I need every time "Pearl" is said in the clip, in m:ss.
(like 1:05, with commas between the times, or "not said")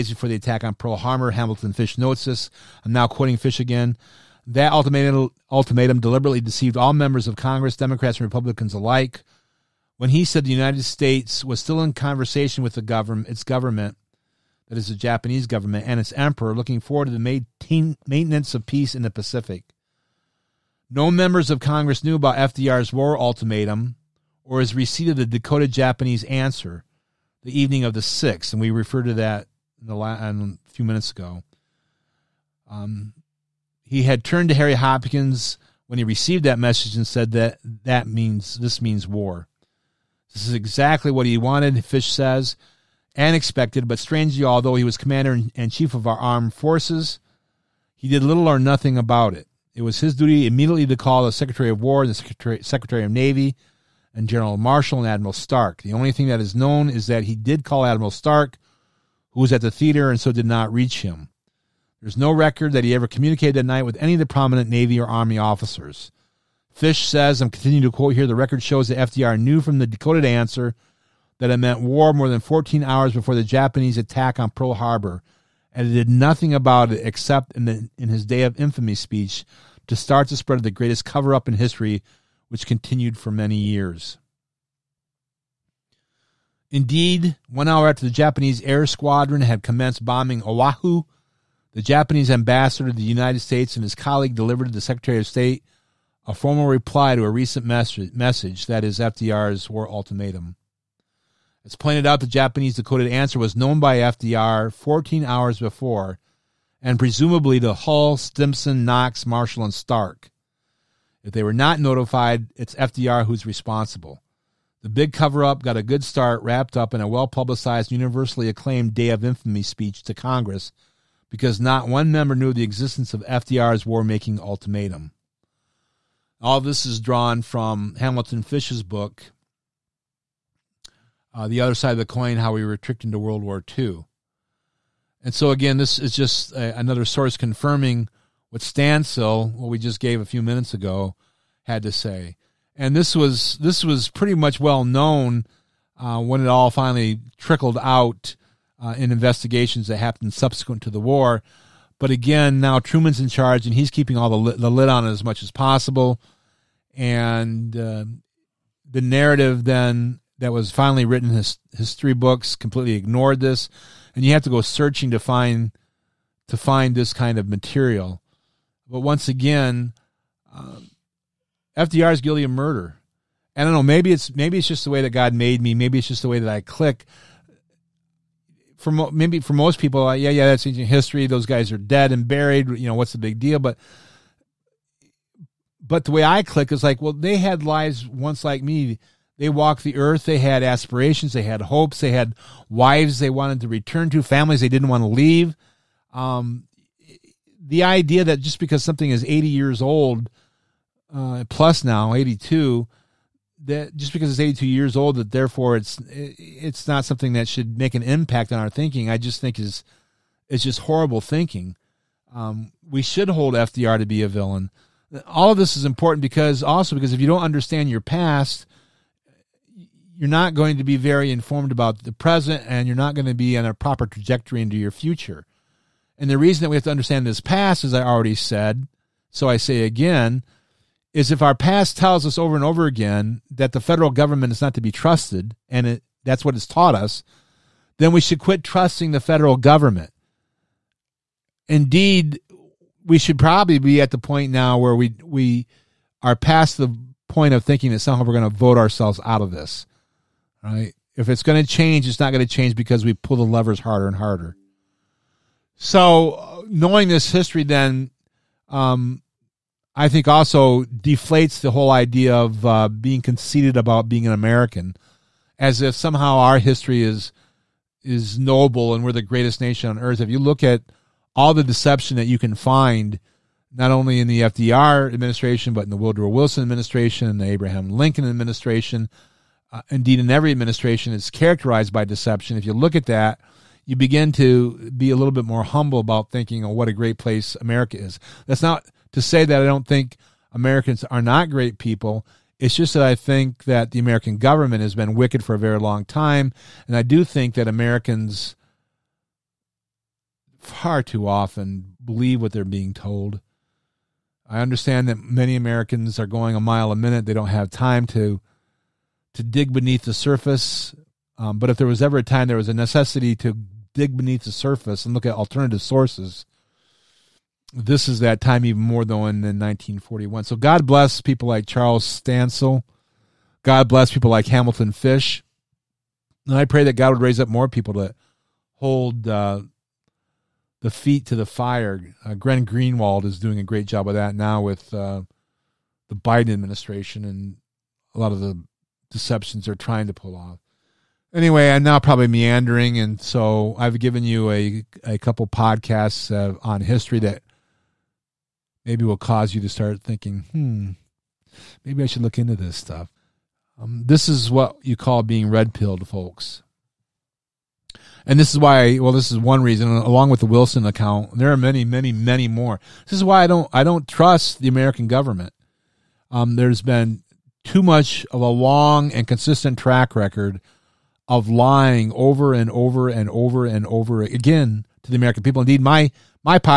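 0:00, 1:14.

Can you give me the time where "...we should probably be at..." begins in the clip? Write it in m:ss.
4:03.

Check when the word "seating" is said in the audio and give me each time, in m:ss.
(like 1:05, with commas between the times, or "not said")
not said.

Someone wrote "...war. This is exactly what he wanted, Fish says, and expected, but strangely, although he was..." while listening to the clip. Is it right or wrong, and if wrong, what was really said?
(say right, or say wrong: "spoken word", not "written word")
right.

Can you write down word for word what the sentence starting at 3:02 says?
You know, what's the big deal?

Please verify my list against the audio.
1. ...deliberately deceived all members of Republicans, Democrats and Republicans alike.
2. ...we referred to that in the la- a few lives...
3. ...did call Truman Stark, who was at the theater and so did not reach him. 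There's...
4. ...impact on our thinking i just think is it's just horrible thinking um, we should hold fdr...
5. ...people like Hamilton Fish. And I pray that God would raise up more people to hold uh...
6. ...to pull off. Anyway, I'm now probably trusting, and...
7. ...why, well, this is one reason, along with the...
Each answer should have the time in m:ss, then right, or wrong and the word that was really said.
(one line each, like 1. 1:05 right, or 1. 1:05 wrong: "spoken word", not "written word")
1. 0:06 wrong: "Congress", not "Republicans"
2. 0:28 wrong: "minutes", not "lives"
3. 0:57 wrong: "Admiral", not "Truman"
4. 3:28 right
5. 5:24 right
6. 5:40 wrong: "meandering", not "trusting"
7. 5:58 right.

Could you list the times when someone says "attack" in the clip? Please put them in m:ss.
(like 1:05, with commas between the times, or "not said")
0:00, 1:13.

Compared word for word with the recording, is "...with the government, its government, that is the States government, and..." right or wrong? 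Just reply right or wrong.
wrong.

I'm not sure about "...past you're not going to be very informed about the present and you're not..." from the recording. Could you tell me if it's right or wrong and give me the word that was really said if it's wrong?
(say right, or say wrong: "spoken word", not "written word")
right.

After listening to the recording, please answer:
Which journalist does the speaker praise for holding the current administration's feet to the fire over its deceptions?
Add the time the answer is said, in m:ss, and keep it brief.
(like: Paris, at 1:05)
Glenn Greenwald, at 5:32.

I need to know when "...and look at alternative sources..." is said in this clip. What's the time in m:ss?
5:15.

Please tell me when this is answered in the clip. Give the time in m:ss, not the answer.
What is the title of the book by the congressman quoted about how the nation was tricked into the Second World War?
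2:11.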